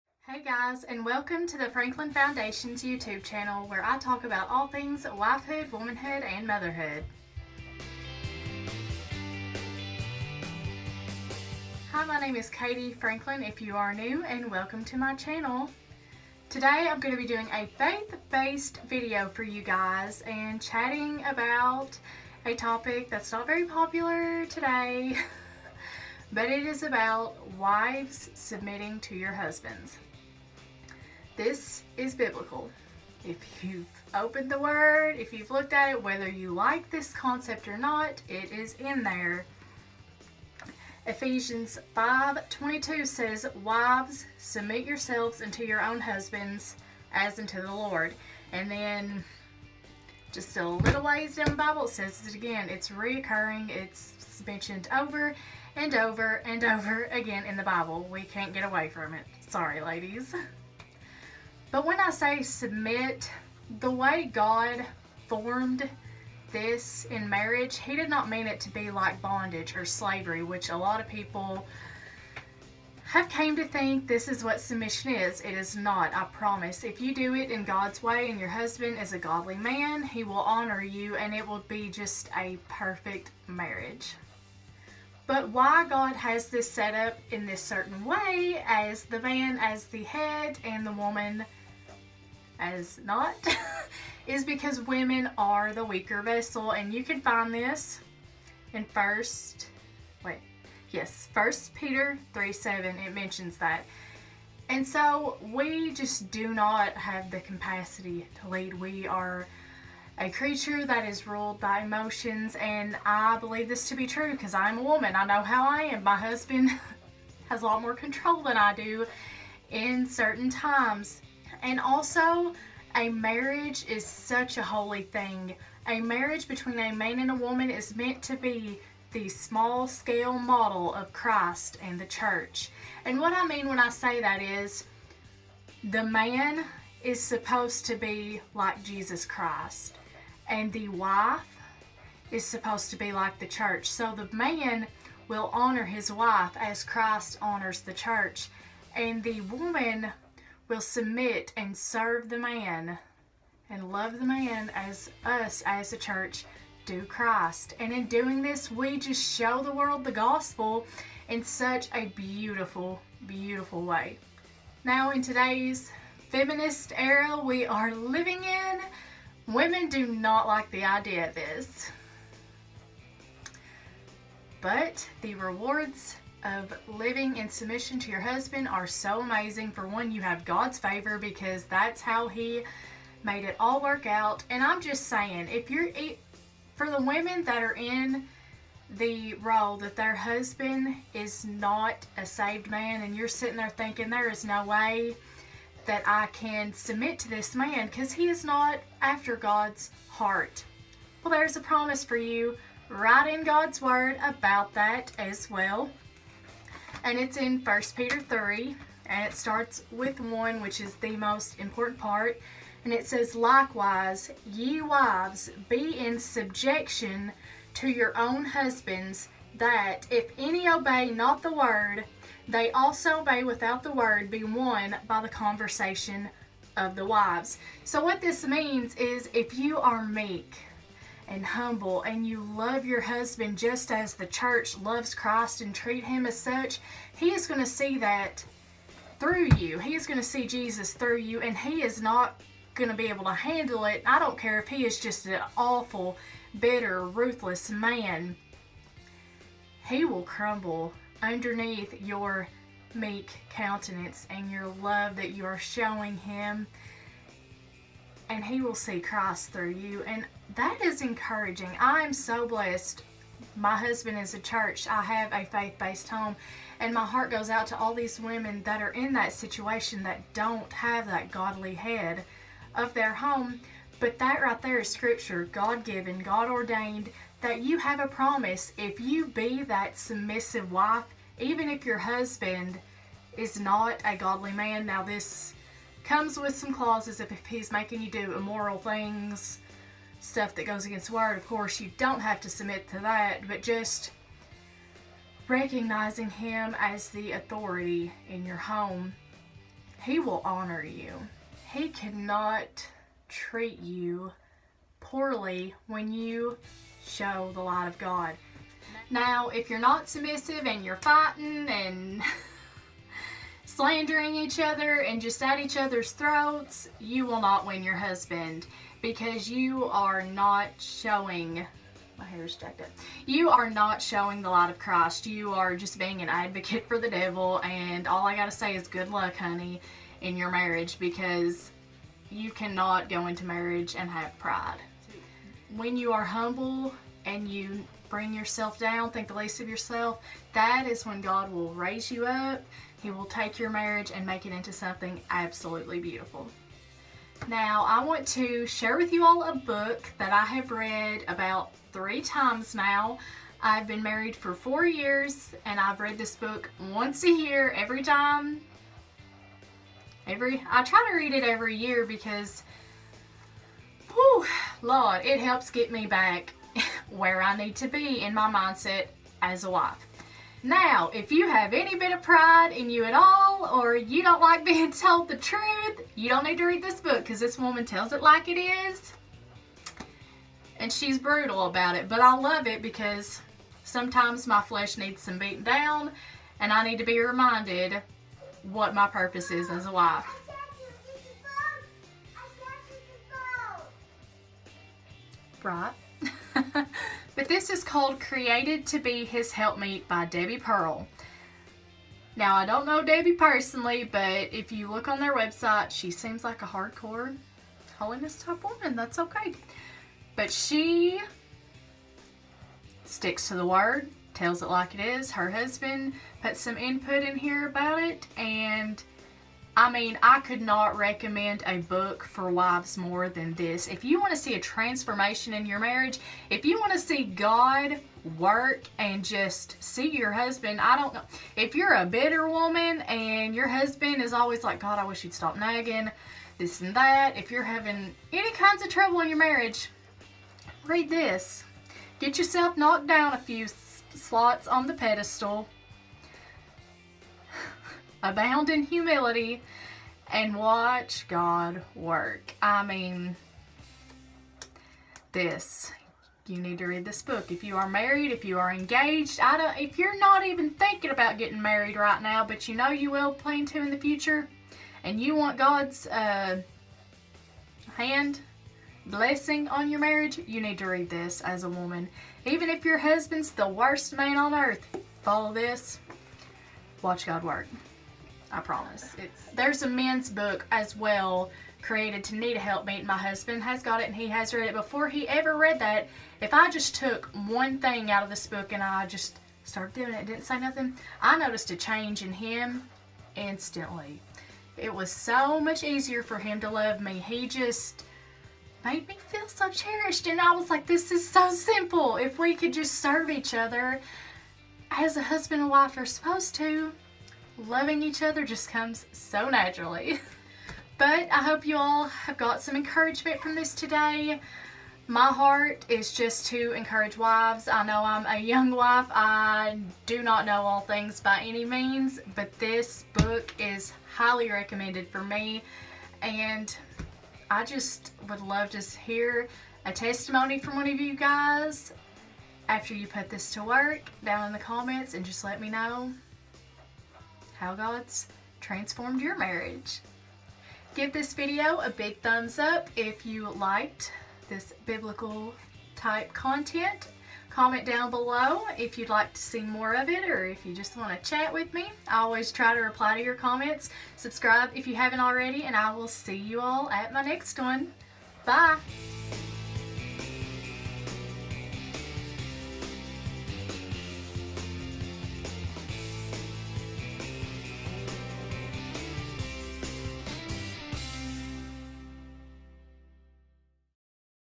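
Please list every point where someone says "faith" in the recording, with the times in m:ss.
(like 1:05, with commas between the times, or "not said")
0:17, 4:25.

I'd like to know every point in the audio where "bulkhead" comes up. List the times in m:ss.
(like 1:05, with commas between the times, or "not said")
not said.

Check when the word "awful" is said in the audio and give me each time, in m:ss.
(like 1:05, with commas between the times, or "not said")
4:05.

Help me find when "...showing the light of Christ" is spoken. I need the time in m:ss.
5:23.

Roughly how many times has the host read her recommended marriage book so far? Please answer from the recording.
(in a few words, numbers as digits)
3.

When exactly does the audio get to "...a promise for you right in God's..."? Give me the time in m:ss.
3:21.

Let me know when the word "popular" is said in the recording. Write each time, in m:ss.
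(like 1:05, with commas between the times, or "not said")
0:23.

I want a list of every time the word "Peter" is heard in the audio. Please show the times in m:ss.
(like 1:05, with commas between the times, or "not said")
1:41, 3:27.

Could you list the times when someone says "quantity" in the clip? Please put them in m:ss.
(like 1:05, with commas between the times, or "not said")
not said.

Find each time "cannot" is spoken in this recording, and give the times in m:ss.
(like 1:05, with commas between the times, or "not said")
5:01, 5:32.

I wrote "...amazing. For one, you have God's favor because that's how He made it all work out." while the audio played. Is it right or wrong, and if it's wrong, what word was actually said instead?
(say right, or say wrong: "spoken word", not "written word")
right.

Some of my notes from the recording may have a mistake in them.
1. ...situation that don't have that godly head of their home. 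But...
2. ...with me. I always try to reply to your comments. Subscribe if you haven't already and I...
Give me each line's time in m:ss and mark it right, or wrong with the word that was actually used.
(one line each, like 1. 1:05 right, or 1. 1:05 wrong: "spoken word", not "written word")
1. 4:29 right
2. 9:11 right.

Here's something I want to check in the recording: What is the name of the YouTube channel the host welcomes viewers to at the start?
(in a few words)
Franklin Foundation.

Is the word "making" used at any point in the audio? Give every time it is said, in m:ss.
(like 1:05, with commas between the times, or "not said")
4:47.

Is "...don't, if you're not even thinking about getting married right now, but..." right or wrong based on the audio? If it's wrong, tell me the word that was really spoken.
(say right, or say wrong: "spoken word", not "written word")
right.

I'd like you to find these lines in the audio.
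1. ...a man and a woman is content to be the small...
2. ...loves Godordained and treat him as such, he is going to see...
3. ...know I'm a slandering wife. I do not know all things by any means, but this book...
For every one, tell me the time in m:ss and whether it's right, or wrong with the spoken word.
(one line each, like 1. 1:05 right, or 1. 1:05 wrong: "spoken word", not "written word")
1. 2:06 wrong: "meant", not "content"
2. 3:54 wrong: "Christ", not "Godordained"
3. 8:37 wrong: "young", not "slandering".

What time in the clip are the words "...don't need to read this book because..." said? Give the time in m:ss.
6:16.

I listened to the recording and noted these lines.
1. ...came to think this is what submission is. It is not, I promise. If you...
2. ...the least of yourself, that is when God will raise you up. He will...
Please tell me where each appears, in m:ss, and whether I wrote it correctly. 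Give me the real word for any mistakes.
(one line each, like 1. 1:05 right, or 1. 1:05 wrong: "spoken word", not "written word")
1. 1:13 right
2. 5:39 right.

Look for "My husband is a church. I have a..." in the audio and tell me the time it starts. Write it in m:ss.
4:23.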